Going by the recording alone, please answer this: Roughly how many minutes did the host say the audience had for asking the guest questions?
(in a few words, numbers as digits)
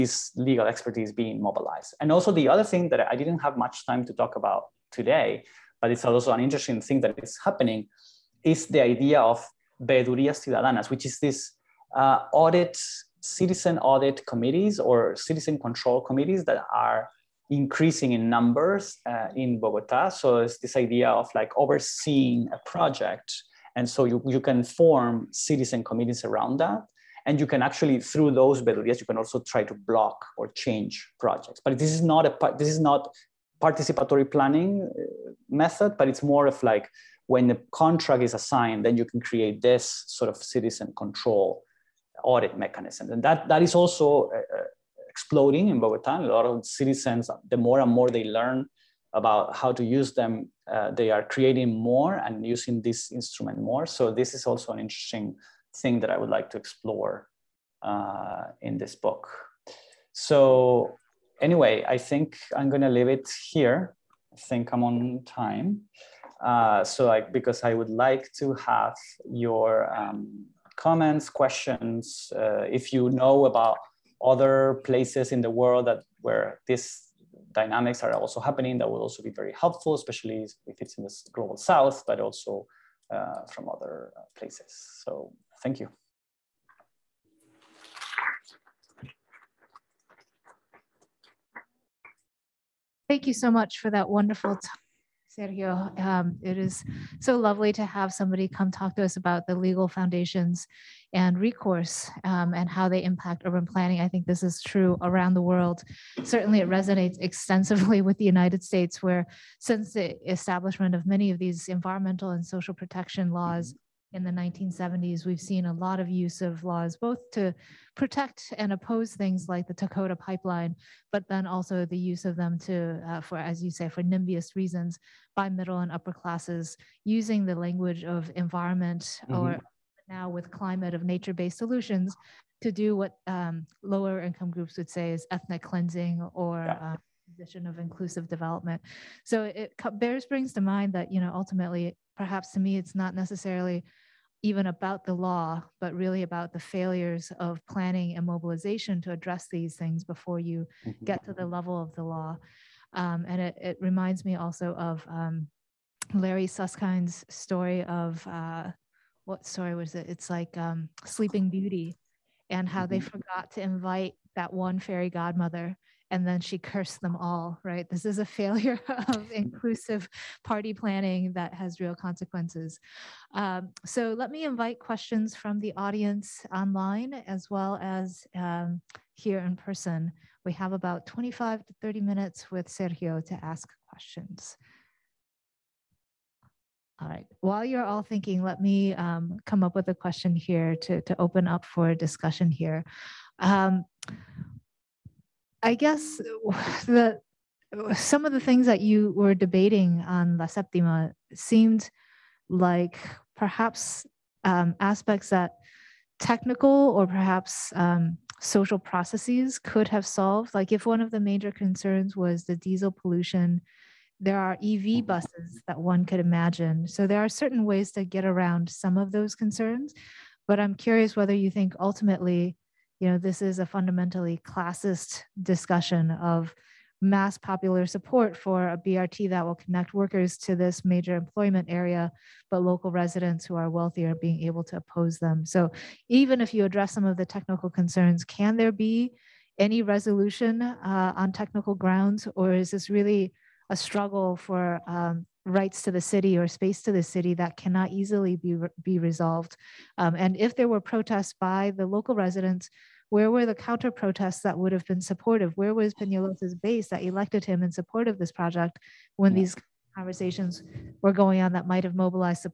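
25 to 30.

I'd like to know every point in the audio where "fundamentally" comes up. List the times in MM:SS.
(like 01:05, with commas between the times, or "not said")
03:43.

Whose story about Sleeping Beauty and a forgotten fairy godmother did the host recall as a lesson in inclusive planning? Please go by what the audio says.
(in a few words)
Larry Susskind.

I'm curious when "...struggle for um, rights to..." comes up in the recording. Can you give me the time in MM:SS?
04:03.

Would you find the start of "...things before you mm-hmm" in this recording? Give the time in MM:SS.
02:29.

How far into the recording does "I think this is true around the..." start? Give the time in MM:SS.
01:43.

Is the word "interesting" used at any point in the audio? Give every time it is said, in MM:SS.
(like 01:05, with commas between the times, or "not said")
00:06, 00:54.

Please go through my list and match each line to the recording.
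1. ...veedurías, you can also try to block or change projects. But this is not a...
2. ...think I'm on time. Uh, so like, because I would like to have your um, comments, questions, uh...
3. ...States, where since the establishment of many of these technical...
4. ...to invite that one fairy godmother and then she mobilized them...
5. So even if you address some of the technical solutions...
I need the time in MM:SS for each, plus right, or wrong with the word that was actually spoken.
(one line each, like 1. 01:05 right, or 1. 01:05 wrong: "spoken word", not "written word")
1. 00:28 right
2. 01:04 right
3. 01:48 wrong: "environmental", not "technical"
4. 02:43 wrong: "cursed", not "mobilized"
5. 03:55 wrong: "concerns", not "solutions".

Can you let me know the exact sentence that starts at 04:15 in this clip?
Where was Peñalosa's base that elected him in support of this project when yeah.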